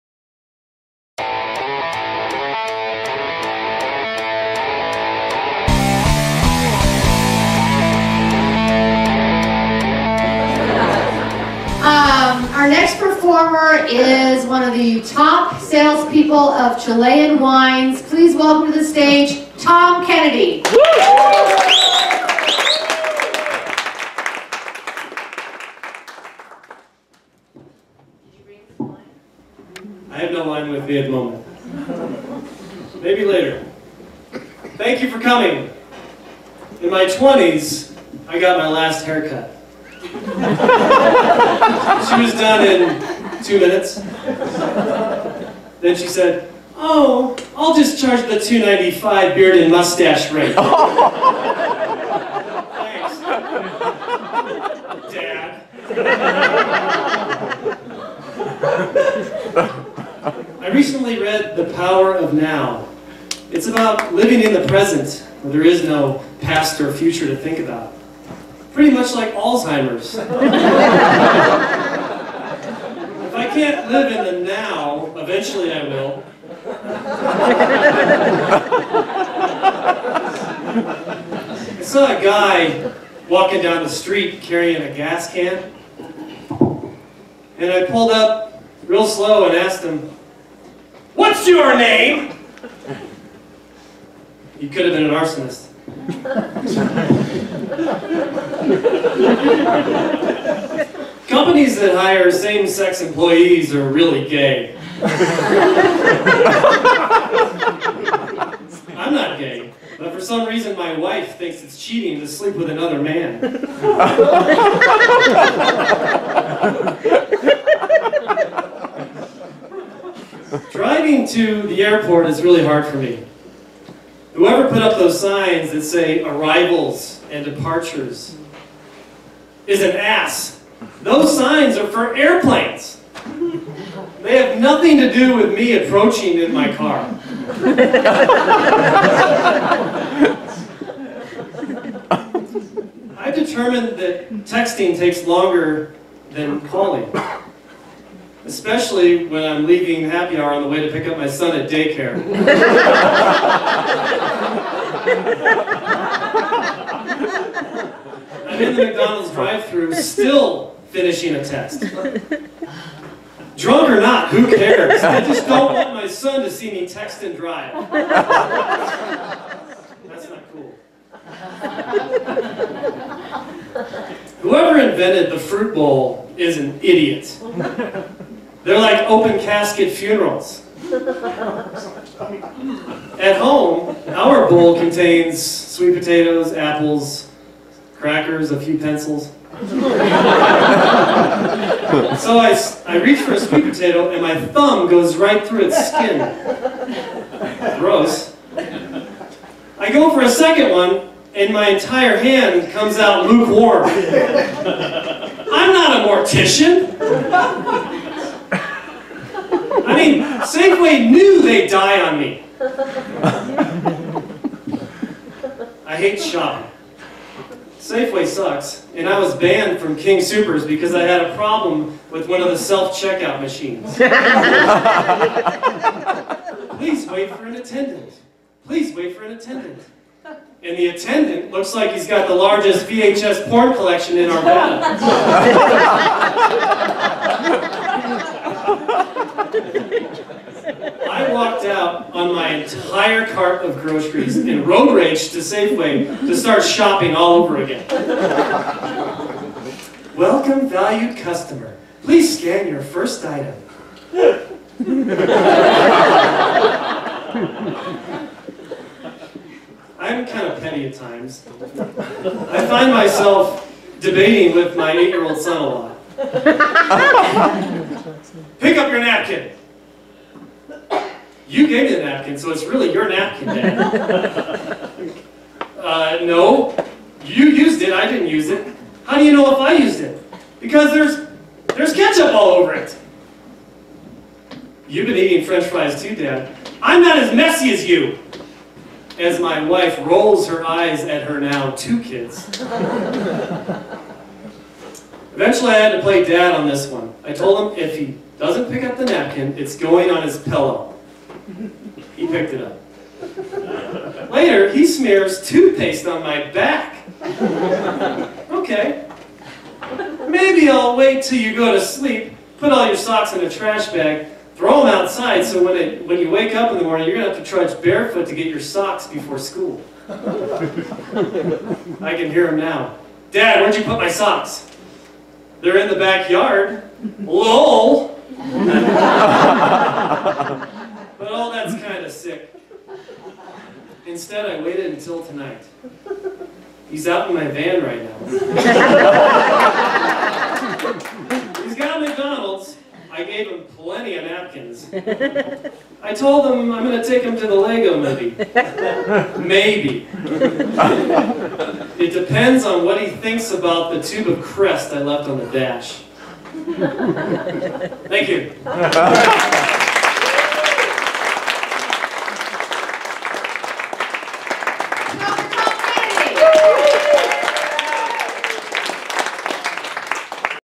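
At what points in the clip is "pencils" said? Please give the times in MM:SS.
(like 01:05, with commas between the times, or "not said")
03:08.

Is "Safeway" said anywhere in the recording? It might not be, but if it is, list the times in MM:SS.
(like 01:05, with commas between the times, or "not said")
03:30, 03:37, 04:05.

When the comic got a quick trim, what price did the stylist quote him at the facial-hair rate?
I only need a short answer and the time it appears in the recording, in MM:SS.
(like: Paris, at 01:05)
$2.95, at 00:48.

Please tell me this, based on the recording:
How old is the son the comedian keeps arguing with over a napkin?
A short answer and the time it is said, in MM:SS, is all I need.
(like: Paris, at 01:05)
8, at 04:24.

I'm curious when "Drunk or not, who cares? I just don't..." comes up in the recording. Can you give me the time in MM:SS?
02:43.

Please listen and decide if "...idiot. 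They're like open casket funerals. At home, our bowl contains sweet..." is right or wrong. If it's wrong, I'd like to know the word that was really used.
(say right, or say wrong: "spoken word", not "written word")
right.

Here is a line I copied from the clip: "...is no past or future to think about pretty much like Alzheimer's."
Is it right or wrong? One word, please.
right.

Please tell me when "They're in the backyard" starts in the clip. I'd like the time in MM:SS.
05:25.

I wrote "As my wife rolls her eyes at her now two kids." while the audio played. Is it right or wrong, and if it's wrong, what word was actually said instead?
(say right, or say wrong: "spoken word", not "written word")
right.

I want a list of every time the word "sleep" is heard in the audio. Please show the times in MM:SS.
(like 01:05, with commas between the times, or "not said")
01:52, 05:11.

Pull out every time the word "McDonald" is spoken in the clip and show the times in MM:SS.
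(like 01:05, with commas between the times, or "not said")
02:38, 05:42.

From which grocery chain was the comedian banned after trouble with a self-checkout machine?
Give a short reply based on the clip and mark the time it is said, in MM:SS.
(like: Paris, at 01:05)
King Supers, at 03:39.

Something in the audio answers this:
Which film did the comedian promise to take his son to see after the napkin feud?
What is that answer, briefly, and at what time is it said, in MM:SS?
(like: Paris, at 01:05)
The Lego Movie, at 05:47.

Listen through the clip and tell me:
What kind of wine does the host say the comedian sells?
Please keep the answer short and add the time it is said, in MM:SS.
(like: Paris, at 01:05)
Chilean wines, at 00:16.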